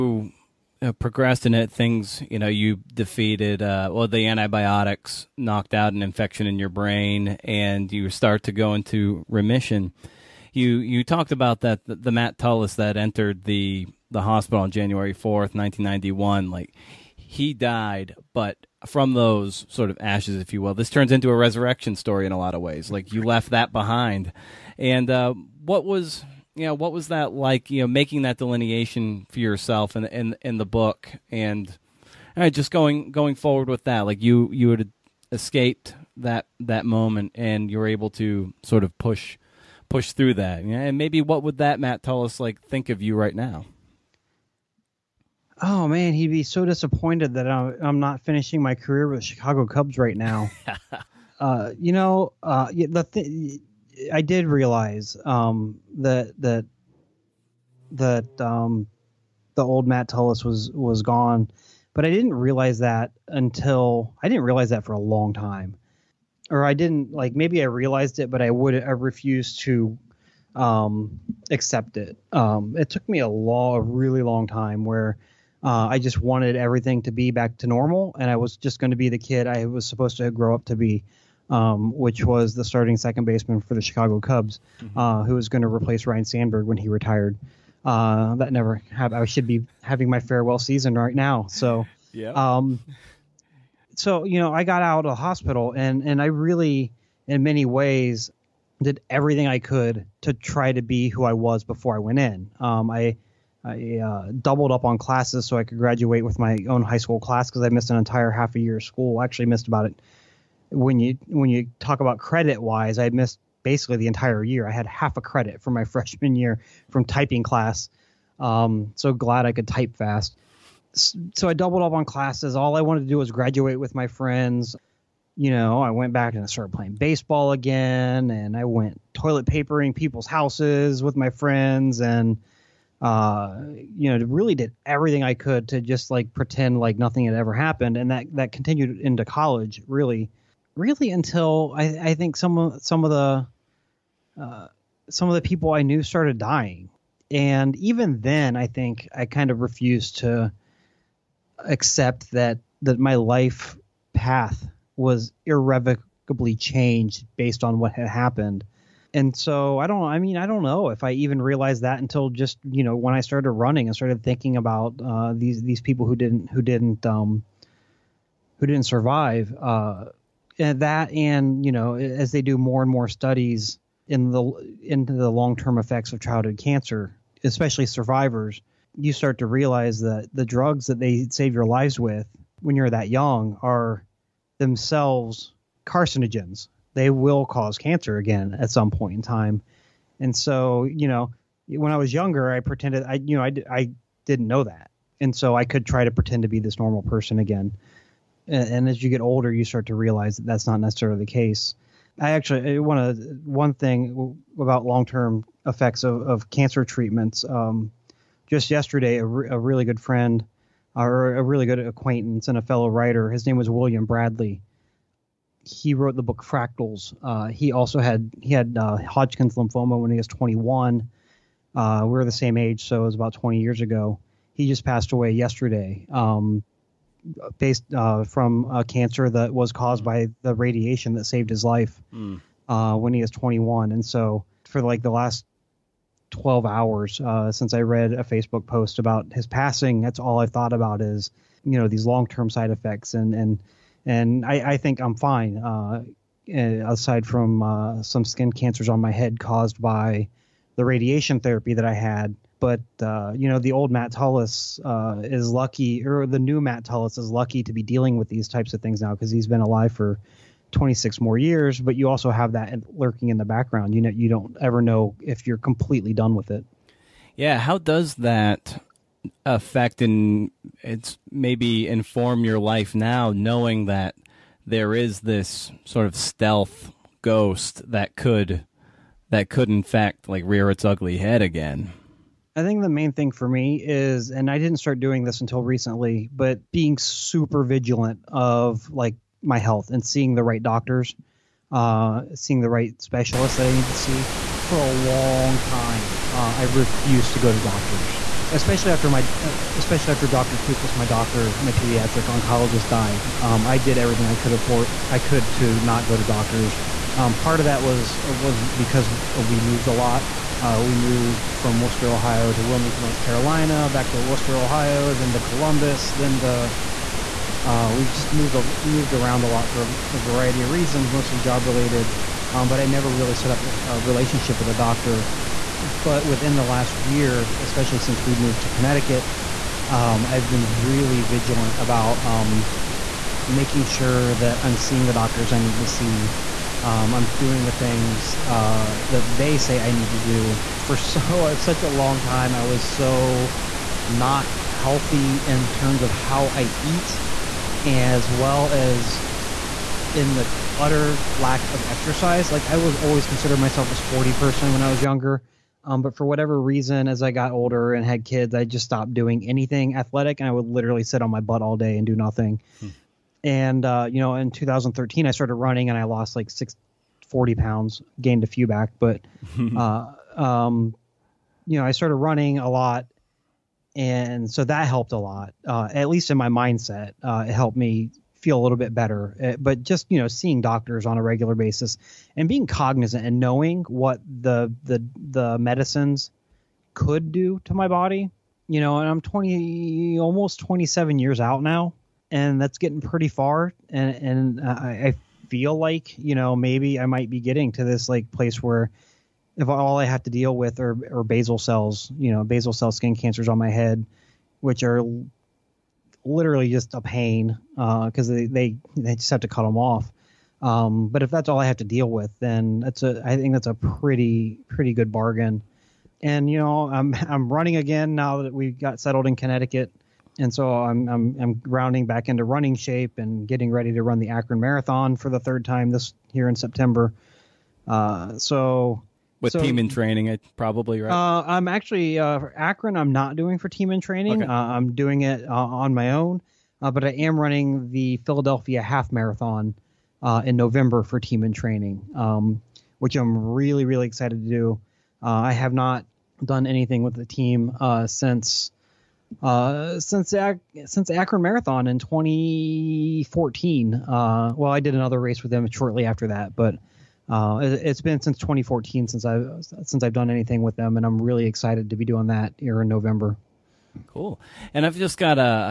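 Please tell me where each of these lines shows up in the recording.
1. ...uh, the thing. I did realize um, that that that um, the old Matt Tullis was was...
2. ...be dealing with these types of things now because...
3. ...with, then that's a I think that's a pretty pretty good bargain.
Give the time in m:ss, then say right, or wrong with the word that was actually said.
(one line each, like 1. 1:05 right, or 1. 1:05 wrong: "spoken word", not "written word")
1. 0:52 right
2. 4:17 right
3. 6:52 right.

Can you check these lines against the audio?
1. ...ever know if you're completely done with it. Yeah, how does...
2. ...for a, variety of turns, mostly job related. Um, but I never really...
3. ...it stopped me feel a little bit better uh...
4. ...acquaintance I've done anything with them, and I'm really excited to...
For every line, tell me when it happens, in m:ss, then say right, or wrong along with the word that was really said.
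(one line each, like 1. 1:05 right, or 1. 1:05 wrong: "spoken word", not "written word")
1. 4:24 right
2. 5:19 wrong: "reasons", not "turns"
3. 6:17 wrong: "helped", not "stopped"
4. 7:39 wrong: "since", not "acquaintance".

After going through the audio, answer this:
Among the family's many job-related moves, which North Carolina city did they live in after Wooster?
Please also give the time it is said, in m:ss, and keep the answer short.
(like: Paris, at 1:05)
Wilmington, at 5:12.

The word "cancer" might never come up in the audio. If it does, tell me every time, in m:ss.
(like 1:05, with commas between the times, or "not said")
2:56, 3:07, 3:26, 3:48, 4:08, 6:43.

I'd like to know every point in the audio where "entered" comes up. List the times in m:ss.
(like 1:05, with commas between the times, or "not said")
0:12.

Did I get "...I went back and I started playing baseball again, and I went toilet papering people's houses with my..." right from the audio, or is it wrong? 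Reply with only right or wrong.
right.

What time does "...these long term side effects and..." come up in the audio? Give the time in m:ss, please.
4:01.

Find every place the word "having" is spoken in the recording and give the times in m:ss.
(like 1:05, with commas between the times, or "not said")
1:29.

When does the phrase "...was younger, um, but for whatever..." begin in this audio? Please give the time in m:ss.
5:54.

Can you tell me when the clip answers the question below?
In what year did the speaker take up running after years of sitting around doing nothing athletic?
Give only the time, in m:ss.
6:04.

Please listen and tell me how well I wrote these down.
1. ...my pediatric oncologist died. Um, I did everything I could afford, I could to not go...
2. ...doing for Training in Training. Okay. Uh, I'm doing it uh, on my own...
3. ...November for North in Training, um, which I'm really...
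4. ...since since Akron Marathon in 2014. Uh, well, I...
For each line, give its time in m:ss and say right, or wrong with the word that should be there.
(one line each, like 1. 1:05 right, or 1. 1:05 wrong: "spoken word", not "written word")
1. 5:01 right
2. 7:13 wrong: "Team", not "Training"
3. 7:20 wrong: "Team", not "North"
4. 7:29 right.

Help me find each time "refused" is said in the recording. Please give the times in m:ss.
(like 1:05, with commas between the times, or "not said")
1:08, 2:29, 4:56.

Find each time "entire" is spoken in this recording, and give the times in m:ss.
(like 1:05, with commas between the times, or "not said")
1:47, 1:54.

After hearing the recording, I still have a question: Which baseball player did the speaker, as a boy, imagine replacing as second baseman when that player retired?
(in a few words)
Ryne Sandberg.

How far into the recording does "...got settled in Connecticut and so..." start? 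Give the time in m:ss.
6:58.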